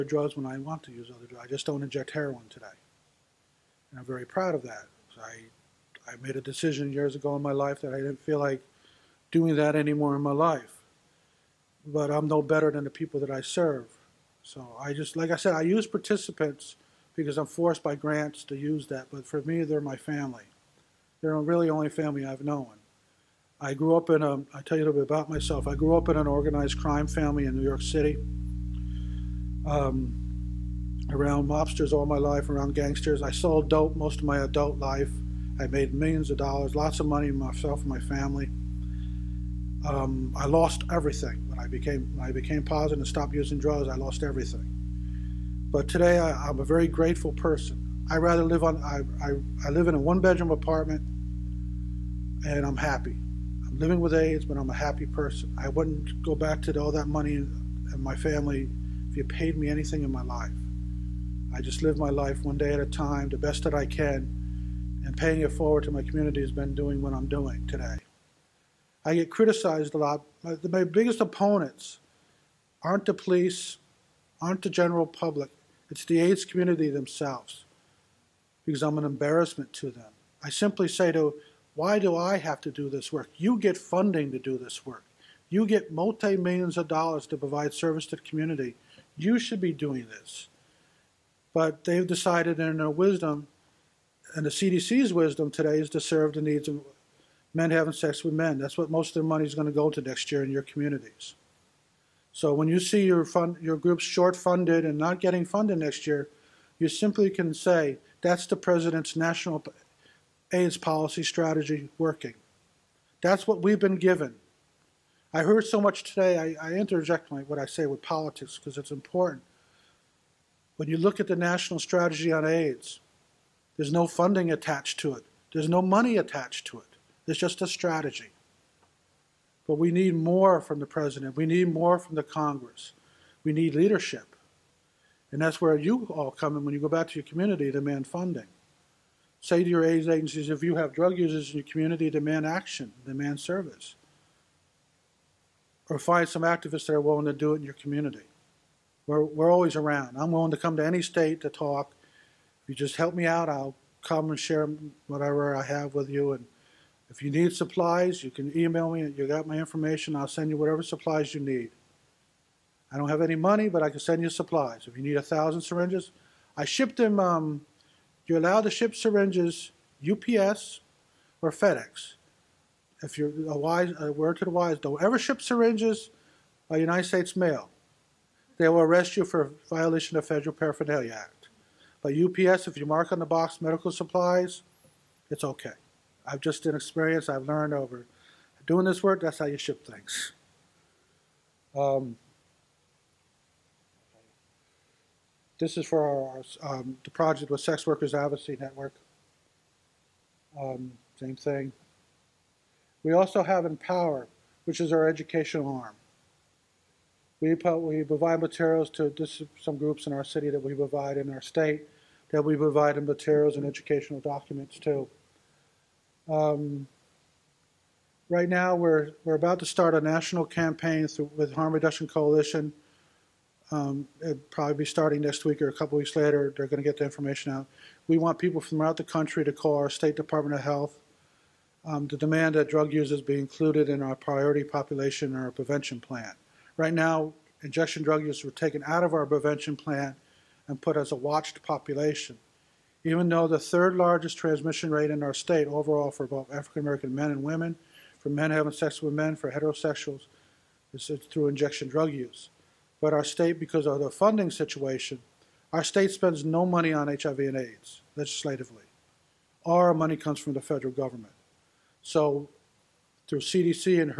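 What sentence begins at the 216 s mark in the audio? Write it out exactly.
Um, right now, we're, we're about to start a national campaign through, with Harm Reduction Coalition.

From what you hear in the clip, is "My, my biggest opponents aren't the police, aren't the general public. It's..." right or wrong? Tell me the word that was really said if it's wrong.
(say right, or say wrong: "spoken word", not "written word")
right.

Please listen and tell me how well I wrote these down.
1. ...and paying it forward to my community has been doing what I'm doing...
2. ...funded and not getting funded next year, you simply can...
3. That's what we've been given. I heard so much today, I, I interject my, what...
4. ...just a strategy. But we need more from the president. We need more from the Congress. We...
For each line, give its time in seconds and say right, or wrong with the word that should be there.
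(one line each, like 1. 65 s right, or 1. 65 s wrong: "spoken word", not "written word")
1. 65 s right
2. 104 s right
3. 113 s right
4. 127 s right.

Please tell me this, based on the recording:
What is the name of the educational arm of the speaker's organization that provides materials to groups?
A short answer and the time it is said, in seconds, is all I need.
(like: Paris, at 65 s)
Empower, at 203 s.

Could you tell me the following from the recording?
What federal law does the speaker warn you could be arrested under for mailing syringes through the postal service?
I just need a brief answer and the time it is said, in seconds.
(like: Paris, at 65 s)
Federal Paraphernalia Act, at 180 s.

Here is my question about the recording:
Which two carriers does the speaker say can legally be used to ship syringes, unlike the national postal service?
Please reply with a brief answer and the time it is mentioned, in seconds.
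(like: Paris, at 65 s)
UPS or FedEx, at 170 s.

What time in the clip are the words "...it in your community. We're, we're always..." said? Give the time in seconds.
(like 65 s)
147 s.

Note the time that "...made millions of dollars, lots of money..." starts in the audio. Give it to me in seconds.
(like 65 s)
35 s.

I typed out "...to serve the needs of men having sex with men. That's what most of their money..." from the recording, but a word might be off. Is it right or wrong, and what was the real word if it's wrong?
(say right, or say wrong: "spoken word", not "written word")
right.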